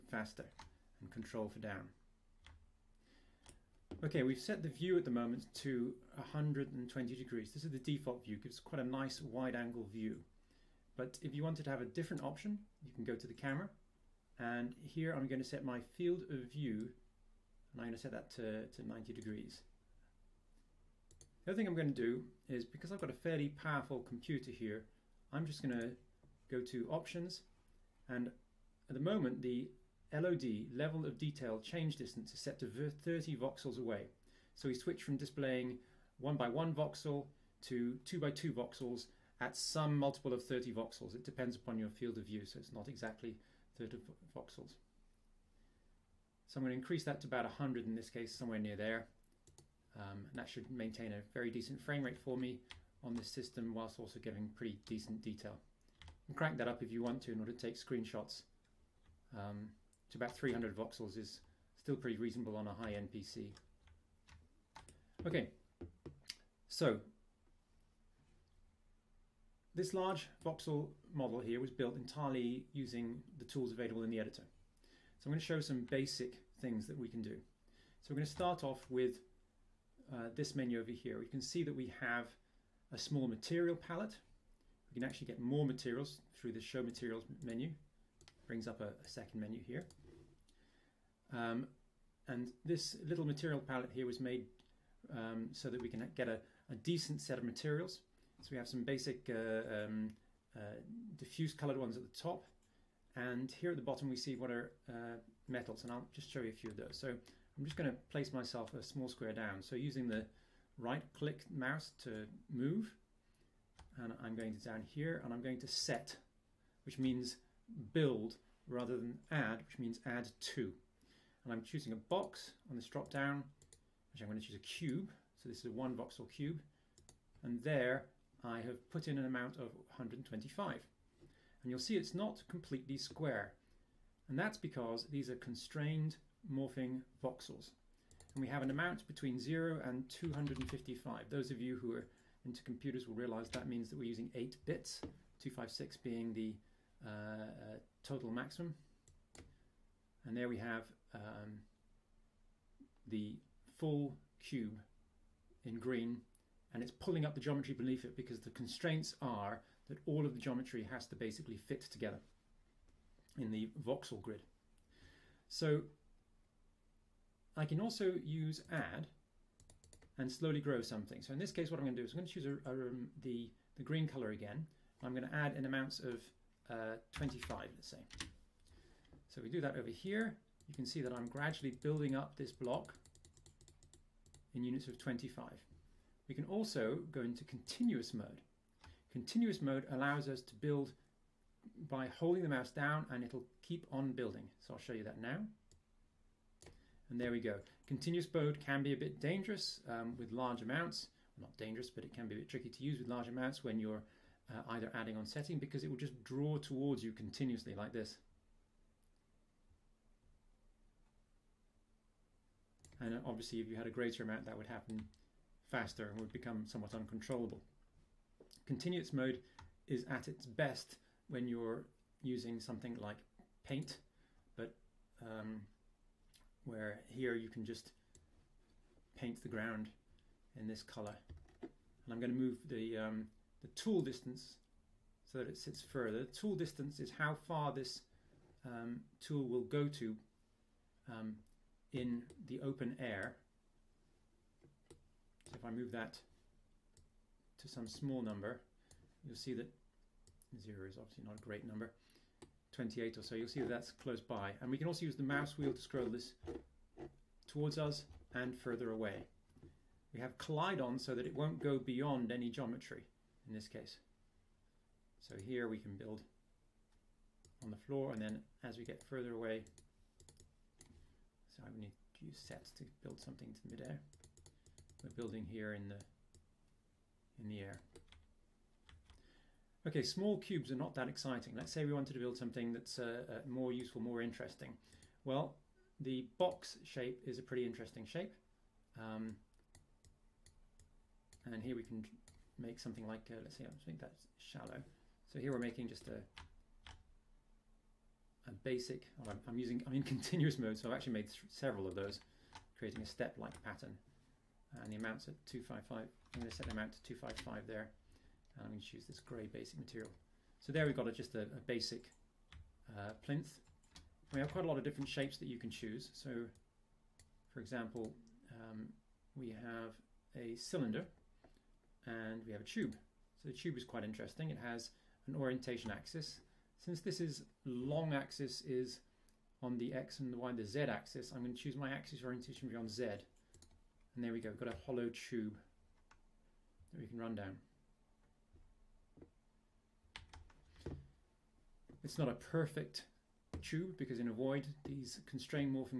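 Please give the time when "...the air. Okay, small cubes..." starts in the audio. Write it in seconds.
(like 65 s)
277 s.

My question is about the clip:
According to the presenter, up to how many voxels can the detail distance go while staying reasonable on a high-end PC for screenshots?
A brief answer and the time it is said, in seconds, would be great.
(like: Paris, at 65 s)
300 voxels, at 60 s.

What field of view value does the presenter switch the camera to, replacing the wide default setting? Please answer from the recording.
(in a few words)
90 degrees.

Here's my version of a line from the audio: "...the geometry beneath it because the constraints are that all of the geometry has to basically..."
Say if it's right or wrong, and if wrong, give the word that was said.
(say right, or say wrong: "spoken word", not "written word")
right.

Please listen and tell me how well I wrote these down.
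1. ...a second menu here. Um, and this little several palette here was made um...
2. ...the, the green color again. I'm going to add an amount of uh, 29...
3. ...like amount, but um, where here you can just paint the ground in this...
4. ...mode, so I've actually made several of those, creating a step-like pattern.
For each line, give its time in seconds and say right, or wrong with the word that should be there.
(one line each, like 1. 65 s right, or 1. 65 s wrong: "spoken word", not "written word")
1. 88 s wrong: "material", not "several"
2. 173 s wrong: "25", not "29"
3. 223 s wrong: "paint", not "amount"
4. 300 s right.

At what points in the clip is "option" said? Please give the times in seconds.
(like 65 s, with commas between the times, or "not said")
12 s, 26 s.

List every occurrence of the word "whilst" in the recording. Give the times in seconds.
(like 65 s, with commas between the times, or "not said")
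53 s.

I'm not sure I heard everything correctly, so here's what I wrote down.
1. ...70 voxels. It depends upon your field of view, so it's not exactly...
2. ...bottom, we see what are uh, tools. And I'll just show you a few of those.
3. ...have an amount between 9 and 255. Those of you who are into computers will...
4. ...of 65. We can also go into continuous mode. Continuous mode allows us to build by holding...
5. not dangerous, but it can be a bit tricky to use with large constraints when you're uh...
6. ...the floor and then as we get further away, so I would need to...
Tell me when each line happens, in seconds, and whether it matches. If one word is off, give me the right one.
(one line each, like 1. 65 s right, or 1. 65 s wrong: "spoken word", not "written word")
1. 40 s wrong: "30", not "70"
2. 103 s wrong: "metals", not "tools"
3. 138 s wrong: "0", not "9"
4. 184 s wrong: "25", not "65"
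5. 201 s wrong: "amounts", not "constraints"
6. 267 s right.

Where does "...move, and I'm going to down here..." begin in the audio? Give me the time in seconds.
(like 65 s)
112 s.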